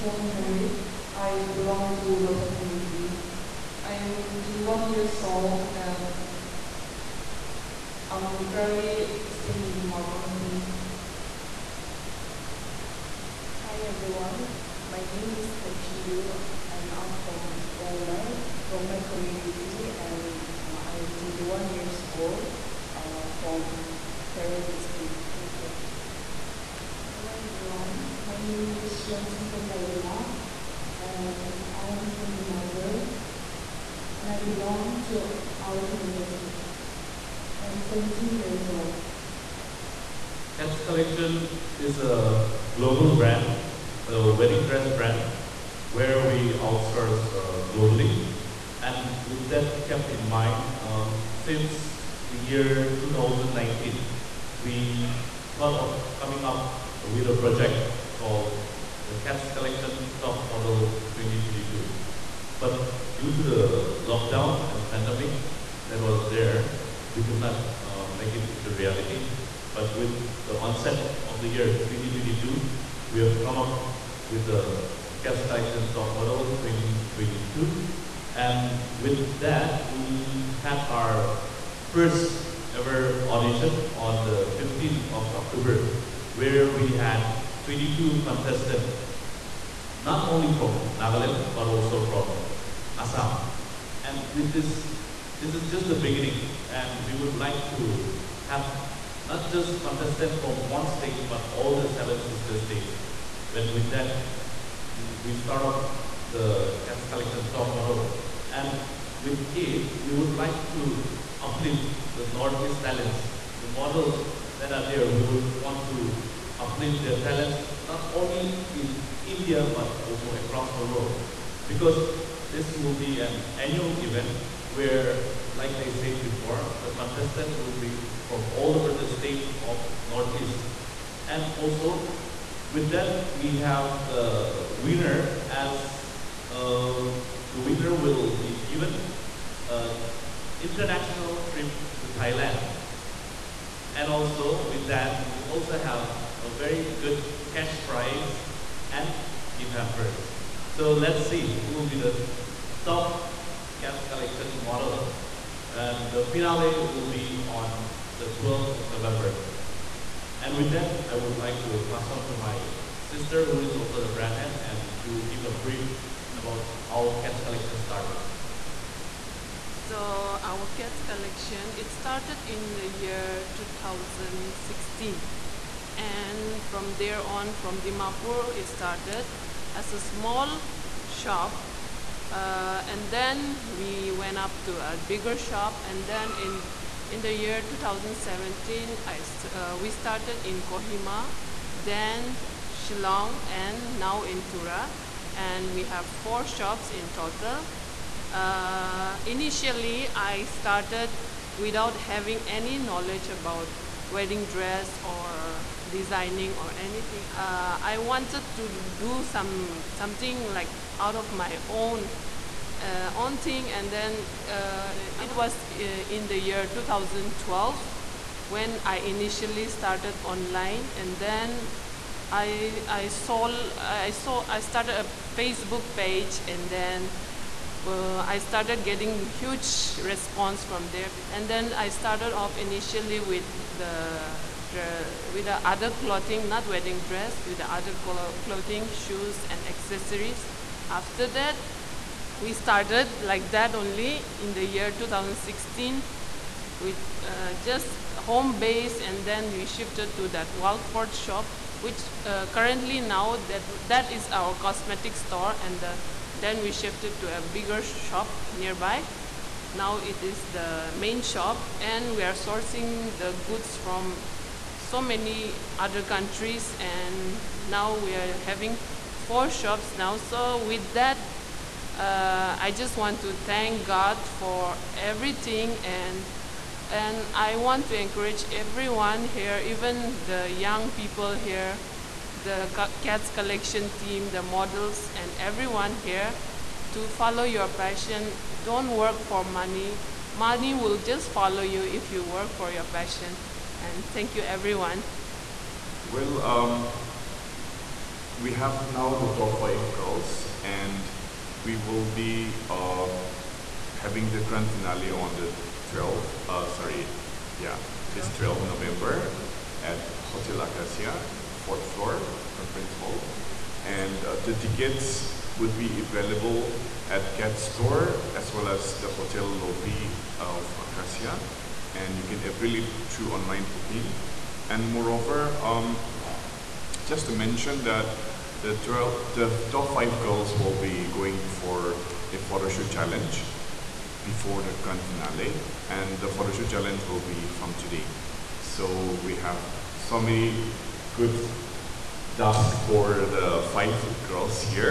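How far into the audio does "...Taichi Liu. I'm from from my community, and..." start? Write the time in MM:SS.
00:15.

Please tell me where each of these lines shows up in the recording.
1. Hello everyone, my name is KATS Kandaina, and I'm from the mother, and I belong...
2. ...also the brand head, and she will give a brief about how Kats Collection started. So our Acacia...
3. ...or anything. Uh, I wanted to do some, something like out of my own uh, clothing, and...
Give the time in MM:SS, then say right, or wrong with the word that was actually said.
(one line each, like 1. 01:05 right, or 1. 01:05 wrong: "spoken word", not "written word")
1. 00:27 wrong: "Ronson", not "KATS"
2. 02:43 wrong: "Kats", not "Acacia"
3. 03:26 wrong: "aunting", not "clothing".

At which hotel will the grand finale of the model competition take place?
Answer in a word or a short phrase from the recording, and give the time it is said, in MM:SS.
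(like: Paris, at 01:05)
Hotel Acacia, at 05:10.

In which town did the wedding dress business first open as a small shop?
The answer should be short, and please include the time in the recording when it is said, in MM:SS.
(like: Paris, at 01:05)
Dimapur, at 02:57.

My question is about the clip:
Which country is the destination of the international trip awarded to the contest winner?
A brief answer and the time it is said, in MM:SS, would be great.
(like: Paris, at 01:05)
Thailand, at 02:22.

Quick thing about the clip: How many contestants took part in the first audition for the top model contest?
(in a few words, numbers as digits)
22.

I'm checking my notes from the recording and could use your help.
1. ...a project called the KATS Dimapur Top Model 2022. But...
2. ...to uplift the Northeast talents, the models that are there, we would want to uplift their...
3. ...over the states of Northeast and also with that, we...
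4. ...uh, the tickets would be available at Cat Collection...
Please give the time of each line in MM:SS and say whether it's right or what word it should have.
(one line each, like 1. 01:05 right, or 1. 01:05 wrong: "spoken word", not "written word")
1. 00:57 wrong: "Collection", not "Dimapur"
2. 01:50 right
3. 02:08 right
4. 05:14 wrong: "Store", not "Collection".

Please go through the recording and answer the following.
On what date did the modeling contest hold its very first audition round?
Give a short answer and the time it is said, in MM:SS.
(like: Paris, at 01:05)
15 October, at 01:24.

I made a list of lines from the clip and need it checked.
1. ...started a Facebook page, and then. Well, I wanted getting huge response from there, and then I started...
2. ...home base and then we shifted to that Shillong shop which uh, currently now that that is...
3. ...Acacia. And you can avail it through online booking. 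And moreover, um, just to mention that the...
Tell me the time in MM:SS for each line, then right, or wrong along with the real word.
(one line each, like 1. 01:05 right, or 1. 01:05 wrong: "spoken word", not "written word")
1. 03:44 wrong: "started", not "wanted"
2. 04:08 wrong: "Walford", not "Shillong"
3. 05:20 right.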